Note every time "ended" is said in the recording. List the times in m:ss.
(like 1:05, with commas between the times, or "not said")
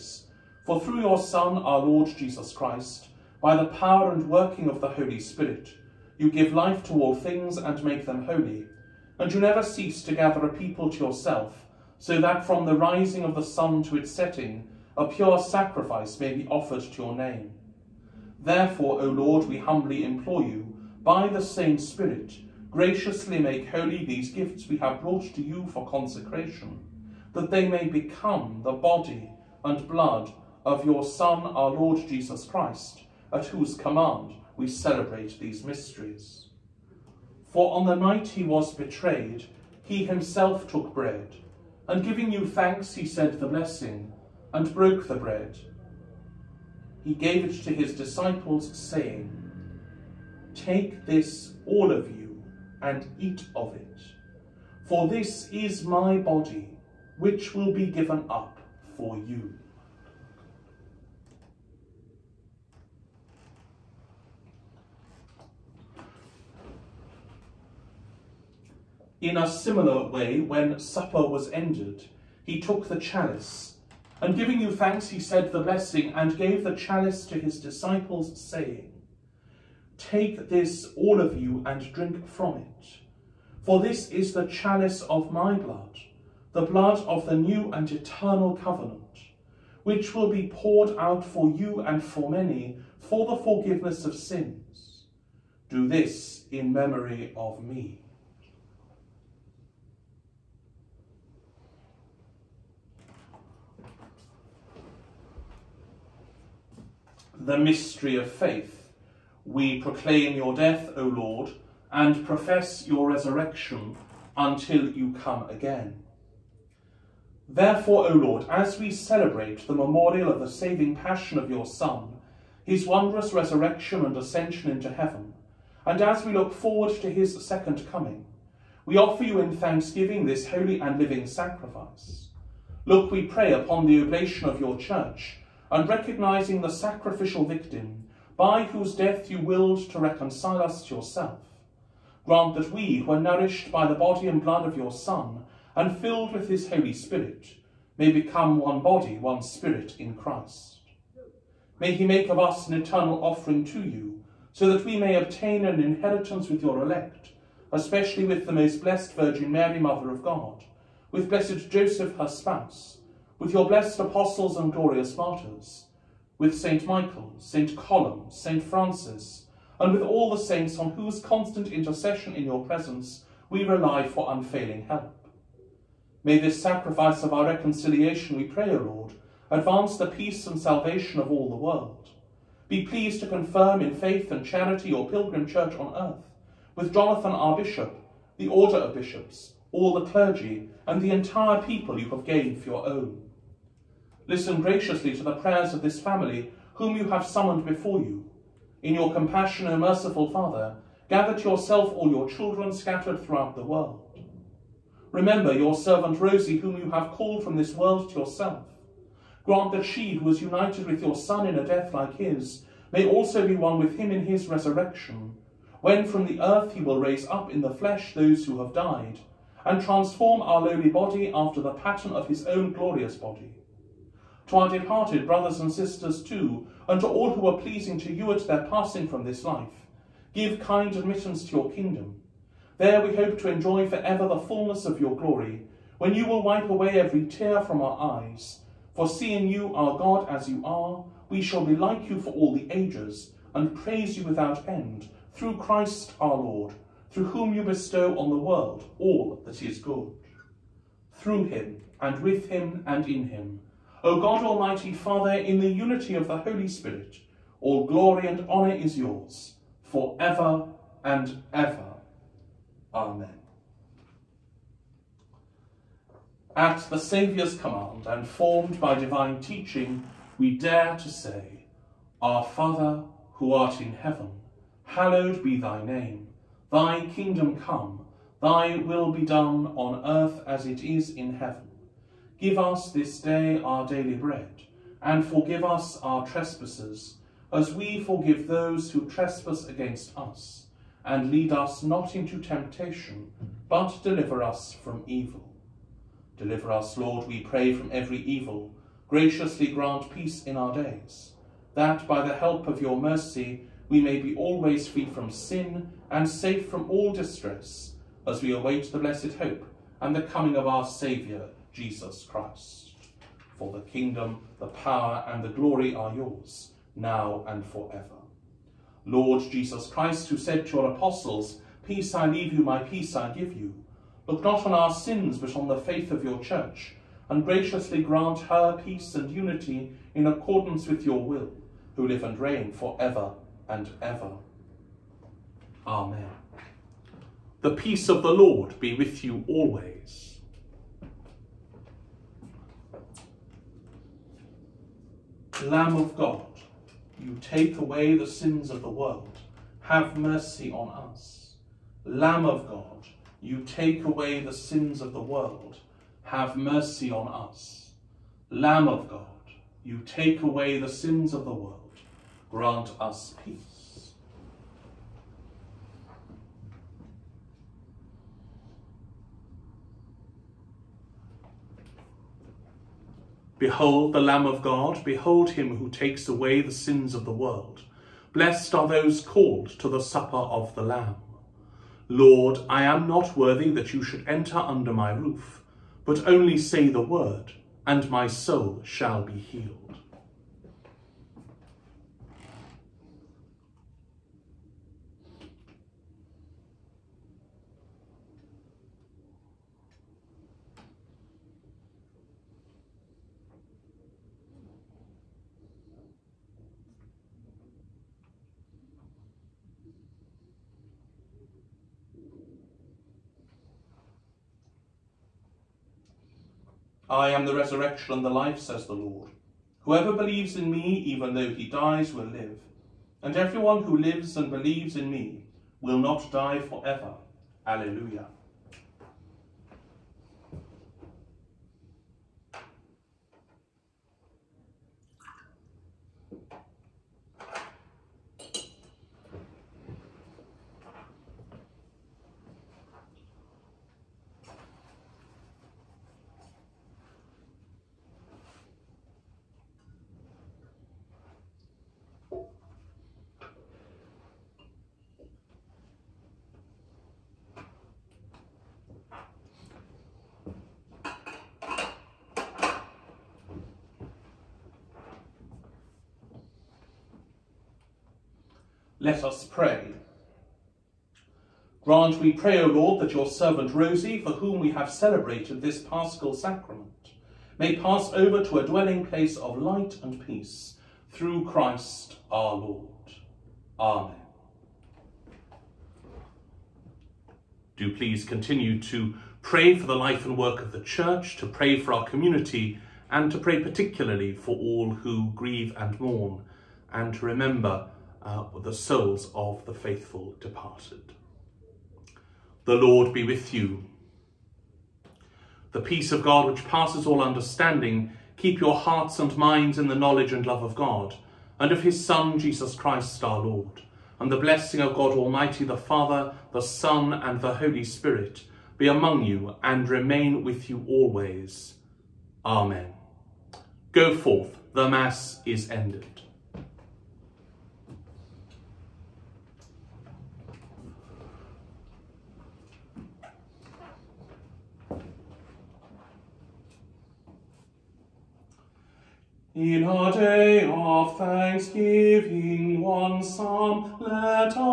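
1:11, 8:45.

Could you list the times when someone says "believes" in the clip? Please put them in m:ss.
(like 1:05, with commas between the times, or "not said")
7:00, 7:04.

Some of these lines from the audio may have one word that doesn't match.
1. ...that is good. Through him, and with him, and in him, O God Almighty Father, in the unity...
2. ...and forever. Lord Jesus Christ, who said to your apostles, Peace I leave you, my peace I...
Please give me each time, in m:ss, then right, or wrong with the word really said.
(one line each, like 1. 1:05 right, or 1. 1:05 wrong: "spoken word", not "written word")
1. 4:09 right
2. 5:17 right.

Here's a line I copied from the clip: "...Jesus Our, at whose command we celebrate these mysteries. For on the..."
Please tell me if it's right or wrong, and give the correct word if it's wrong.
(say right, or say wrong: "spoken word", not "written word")
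wrong: "Christ", not "Our".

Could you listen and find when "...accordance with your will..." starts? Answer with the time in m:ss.
5:30.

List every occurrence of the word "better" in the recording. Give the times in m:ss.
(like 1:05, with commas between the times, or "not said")
not said.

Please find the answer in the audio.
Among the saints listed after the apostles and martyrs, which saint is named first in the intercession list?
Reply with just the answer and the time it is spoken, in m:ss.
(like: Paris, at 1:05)
St. Michael, at 2:46.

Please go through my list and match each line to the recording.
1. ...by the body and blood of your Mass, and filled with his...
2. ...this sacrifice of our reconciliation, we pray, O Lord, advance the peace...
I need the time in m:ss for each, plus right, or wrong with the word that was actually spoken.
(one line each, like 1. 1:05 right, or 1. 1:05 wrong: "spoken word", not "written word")
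1. 2:23 wrong: "Son", not "Mass"
2. 2:56 right.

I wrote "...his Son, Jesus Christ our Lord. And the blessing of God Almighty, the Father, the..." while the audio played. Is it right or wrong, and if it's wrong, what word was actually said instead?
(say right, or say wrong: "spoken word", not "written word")
right.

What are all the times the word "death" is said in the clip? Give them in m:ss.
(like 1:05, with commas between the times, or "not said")
1:50, 2:18, 3:31.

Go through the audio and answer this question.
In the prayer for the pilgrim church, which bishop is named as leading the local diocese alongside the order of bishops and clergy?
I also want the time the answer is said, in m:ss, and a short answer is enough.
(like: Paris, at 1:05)
Jonathan, at 3:06.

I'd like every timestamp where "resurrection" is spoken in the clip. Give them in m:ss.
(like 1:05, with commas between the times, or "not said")
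1:53, 2:03, 3:34, 6:57.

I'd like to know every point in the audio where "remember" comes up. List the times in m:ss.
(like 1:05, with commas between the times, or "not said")
3:25, 8:17.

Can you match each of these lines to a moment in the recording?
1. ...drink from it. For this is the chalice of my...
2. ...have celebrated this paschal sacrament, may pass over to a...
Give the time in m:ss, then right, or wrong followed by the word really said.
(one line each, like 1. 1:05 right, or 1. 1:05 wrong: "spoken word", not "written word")
1. 1:21 right
2. 7:54 right.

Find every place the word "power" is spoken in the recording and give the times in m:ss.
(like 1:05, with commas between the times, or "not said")
0:03, 5:14.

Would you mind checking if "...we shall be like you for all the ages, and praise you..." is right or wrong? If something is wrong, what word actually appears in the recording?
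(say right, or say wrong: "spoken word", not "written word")
right.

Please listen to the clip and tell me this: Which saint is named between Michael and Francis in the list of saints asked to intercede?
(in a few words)
St. Columb.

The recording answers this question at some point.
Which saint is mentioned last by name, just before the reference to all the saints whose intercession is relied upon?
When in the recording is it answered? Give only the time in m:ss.
2:48.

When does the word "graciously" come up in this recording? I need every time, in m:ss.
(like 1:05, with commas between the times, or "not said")
0:22, 3:14, 4:59, 5:27.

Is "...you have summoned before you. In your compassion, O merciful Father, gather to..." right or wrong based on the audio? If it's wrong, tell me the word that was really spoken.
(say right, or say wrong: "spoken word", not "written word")
right.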